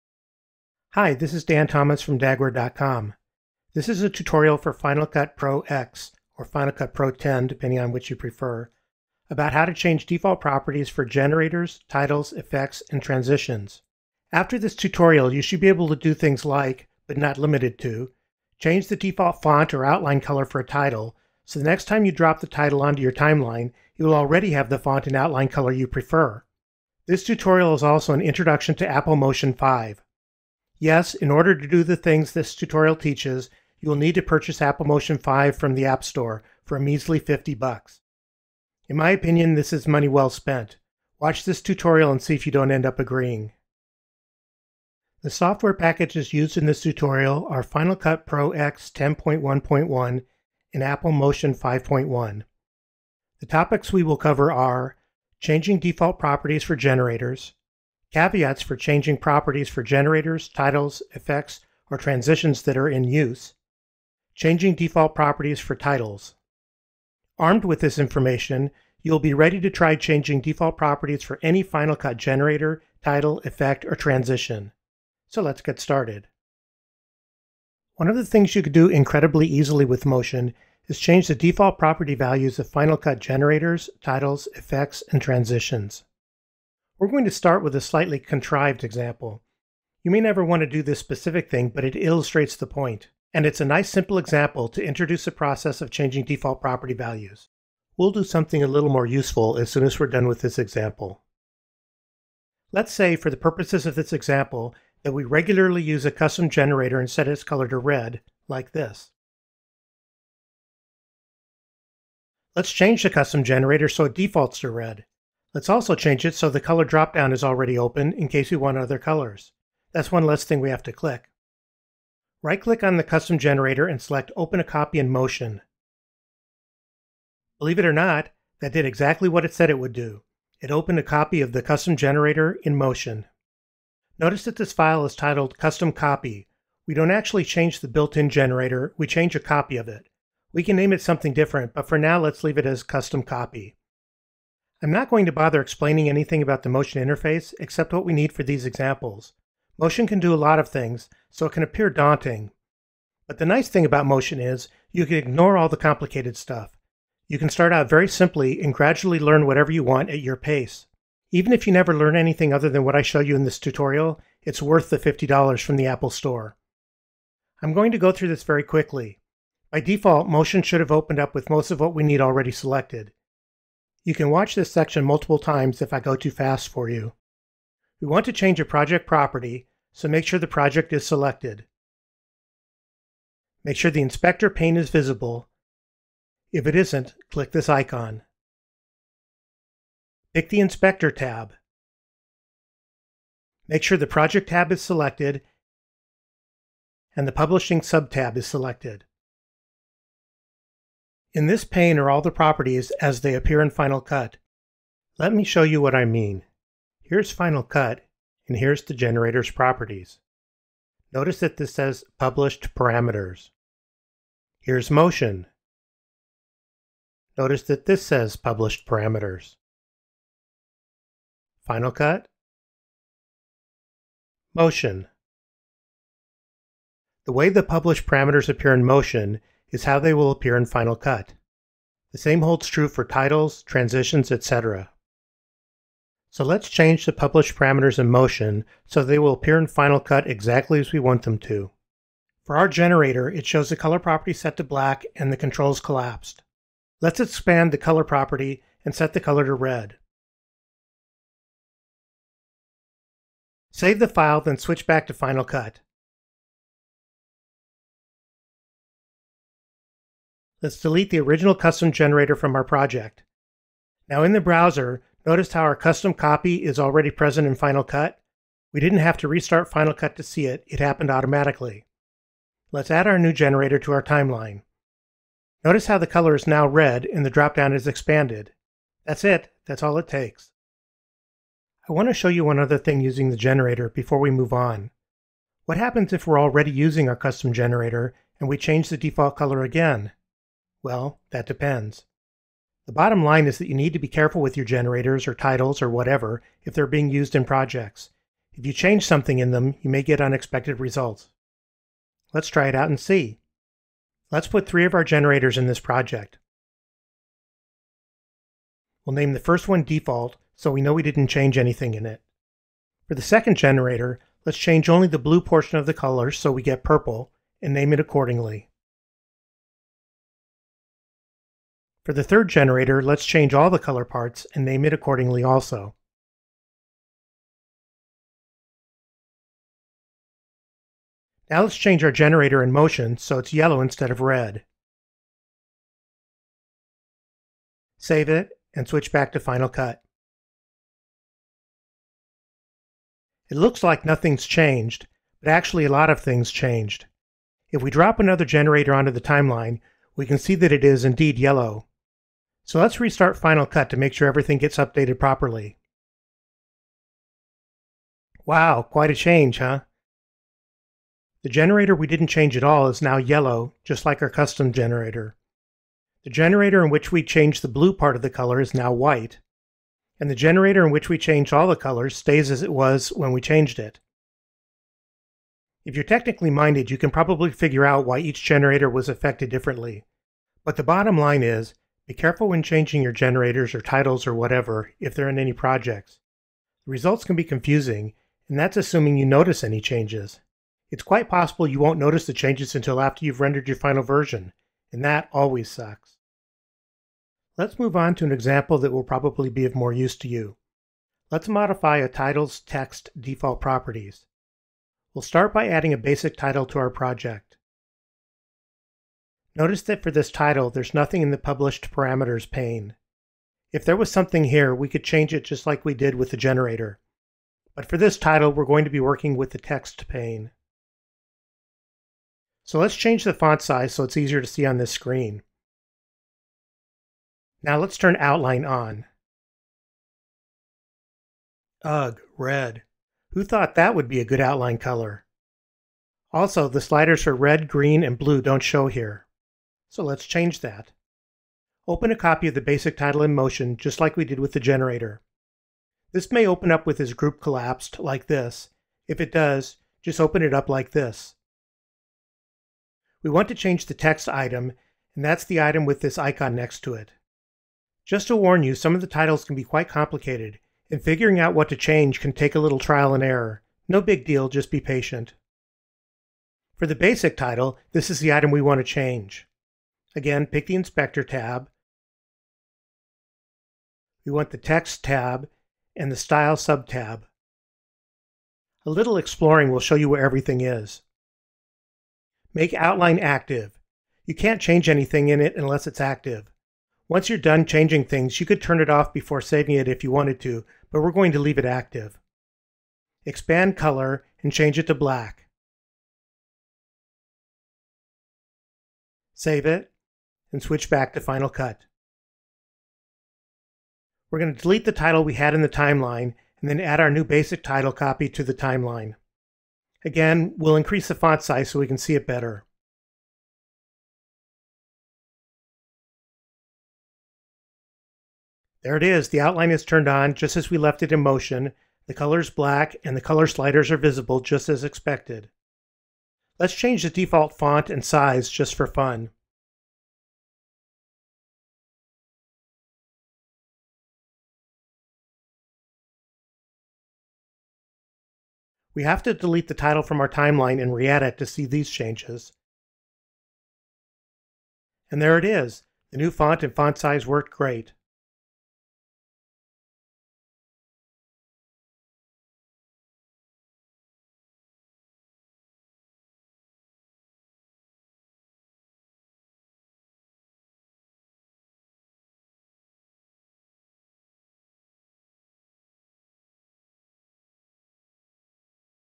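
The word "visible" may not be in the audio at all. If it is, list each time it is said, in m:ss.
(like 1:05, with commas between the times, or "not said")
3:04, 8:43.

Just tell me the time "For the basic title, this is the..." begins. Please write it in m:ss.
7:46.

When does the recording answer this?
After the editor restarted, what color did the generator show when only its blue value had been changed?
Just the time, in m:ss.
6:08.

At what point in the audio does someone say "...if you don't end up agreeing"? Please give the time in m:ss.
0:42.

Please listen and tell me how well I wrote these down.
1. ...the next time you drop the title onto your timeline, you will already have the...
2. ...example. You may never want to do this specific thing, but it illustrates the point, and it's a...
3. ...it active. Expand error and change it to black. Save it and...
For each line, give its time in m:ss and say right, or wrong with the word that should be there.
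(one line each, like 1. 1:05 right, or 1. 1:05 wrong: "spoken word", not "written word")
1. 0:21 right
2. 1:28 right
3. 8:11 wrong: "color", not "error".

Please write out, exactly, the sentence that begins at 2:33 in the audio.
But the nice thing about motion is you can ignore all the complicated stuff.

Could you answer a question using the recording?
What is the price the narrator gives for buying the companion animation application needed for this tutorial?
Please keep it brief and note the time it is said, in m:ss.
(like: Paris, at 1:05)
$50, at 0:37.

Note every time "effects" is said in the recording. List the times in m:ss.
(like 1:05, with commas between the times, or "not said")
0:12, 1:01, 1:13, 1:24.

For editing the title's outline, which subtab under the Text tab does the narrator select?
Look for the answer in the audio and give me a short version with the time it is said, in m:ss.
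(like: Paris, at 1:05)
Style, at 7:56.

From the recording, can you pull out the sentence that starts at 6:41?
Let's modify a title's text default properties.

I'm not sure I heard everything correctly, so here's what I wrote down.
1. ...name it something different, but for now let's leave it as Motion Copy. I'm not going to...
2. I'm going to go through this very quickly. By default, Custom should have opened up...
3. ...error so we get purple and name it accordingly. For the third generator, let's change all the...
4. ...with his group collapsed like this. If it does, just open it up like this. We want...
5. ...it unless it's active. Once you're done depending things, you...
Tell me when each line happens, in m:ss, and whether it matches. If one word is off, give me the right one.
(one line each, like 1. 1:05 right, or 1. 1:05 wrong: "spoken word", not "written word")
1. 2:20 wrong: "Custom", not "Motion"
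2. 2:47 wrong: "Motion", not "Custom"
3. 5:15 wrong: "color", not "error"
4. 7:26 right
5. 8:05 wrong: "changing", not "depending".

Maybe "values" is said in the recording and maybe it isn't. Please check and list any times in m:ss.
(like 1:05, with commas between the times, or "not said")
1:22, 1:36.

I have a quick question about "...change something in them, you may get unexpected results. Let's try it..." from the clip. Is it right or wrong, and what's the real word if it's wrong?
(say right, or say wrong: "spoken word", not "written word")
right.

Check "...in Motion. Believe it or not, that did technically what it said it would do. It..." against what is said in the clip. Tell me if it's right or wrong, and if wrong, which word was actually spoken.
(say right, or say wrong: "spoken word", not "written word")
wrong: "exactly", not "technically".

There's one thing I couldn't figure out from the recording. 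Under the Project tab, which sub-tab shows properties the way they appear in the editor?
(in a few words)
Publishing.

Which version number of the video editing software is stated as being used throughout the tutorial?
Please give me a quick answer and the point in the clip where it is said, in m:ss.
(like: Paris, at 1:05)
10.1.1, at 0:48.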